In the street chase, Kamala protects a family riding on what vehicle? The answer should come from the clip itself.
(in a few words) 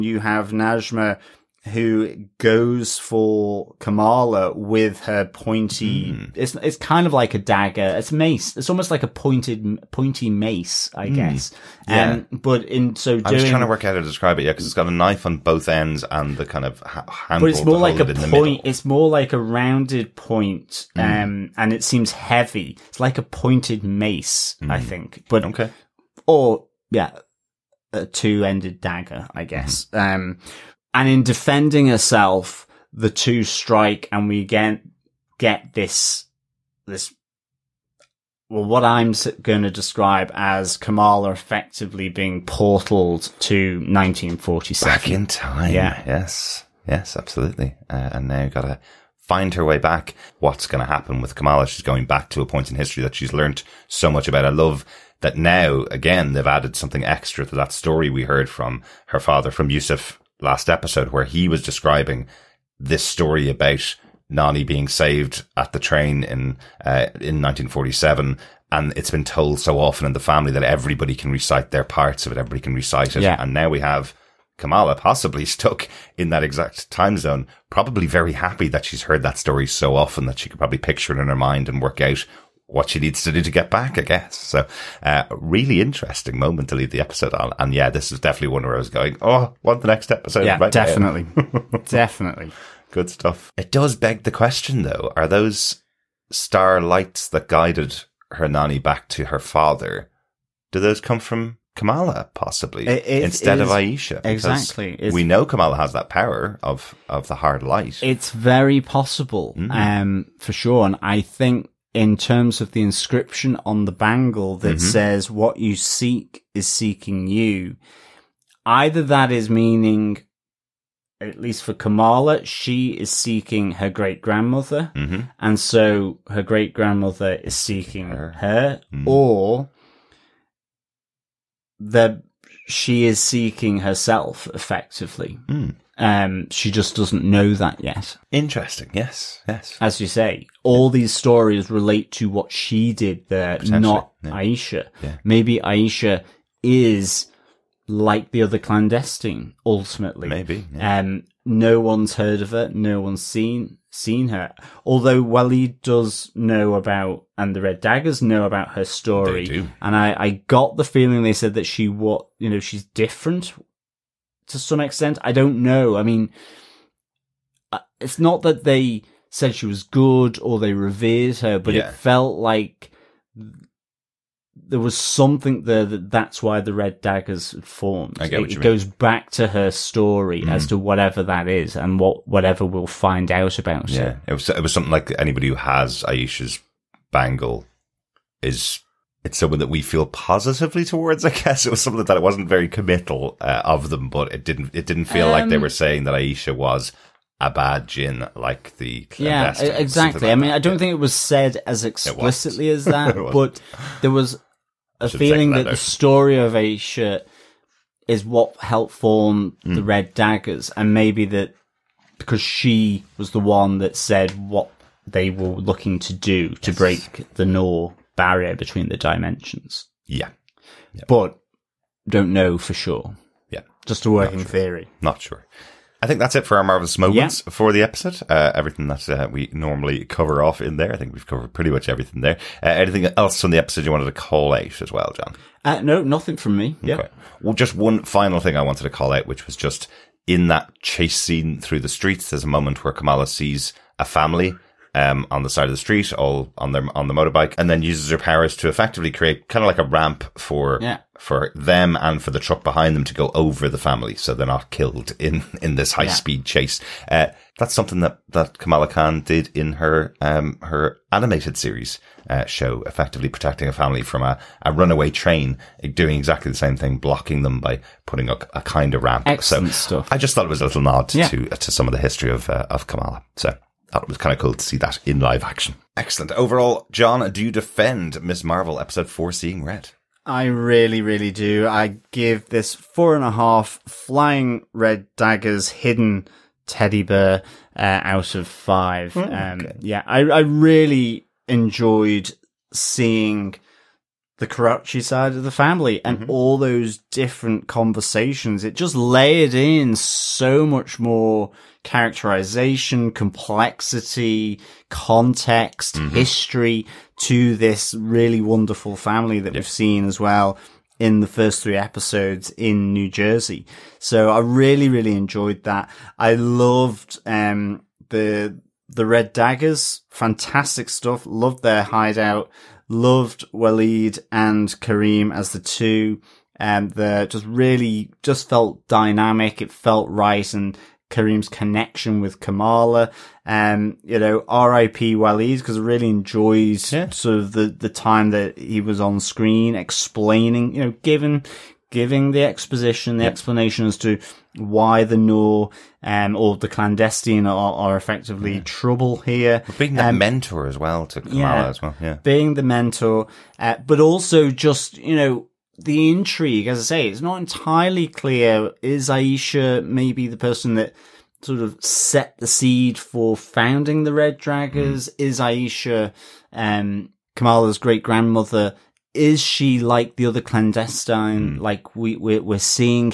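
motorbike.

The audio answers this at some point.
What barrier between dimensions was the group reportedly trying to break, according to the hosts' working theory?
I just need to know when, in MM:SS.
03:37.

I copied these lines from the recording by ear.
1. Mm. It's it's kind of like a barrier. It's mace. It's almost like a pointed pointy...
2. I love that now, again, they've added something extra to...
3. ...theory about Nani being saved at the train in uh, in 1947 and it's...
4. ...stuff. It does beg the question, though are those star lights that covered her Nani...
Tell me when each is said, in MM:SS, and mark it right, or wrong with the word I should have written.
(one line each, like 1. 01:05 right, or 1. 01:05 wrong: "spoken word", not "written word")
1. 00:06 wrong: "dagger", not "barrier"
2. 00:54 right
3. 01:03 wrong: "story", not "theory"
4. 01:33 wrong: "guided", not "covered".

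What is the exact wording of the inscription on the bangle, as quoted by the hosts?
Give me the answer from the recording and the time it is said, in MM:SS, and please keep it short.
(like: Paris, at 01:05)
What you seek is seeking you, at 01:55.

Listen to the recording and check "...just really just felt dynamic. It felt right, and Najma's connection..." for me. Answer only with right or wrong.
wrong.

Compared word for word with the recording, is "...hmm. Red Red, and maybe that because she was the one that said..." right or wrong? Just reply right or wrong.
wrong.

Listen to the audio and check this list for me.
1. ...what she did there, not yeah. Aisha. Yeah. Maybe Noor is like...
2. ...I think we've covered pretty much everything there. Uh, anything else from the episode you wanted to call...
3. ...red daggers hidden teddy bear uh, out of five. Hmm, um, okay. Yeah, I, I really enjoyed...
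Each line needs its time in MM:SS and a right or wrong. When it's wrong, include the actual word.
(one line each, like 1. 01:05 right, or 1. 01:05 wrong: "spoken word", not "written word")
1. 02:22 wrong: "Aisha", not "Noor"
2. 03:50 right
3. 04:44 right.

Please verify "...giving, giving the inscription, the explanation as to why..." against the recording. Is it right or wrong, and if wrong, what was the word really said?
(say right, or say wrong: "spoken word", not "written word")
wrong: "exposition", not "inscription".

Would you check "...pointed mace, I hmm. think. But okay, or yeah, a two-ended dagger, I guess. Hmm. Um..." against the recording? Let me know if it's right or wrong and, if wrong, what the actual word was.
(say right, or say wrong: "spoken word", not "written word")
right.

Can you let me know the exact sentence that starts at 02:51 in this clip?
it felt like there was something there that that's why the red daggers formed.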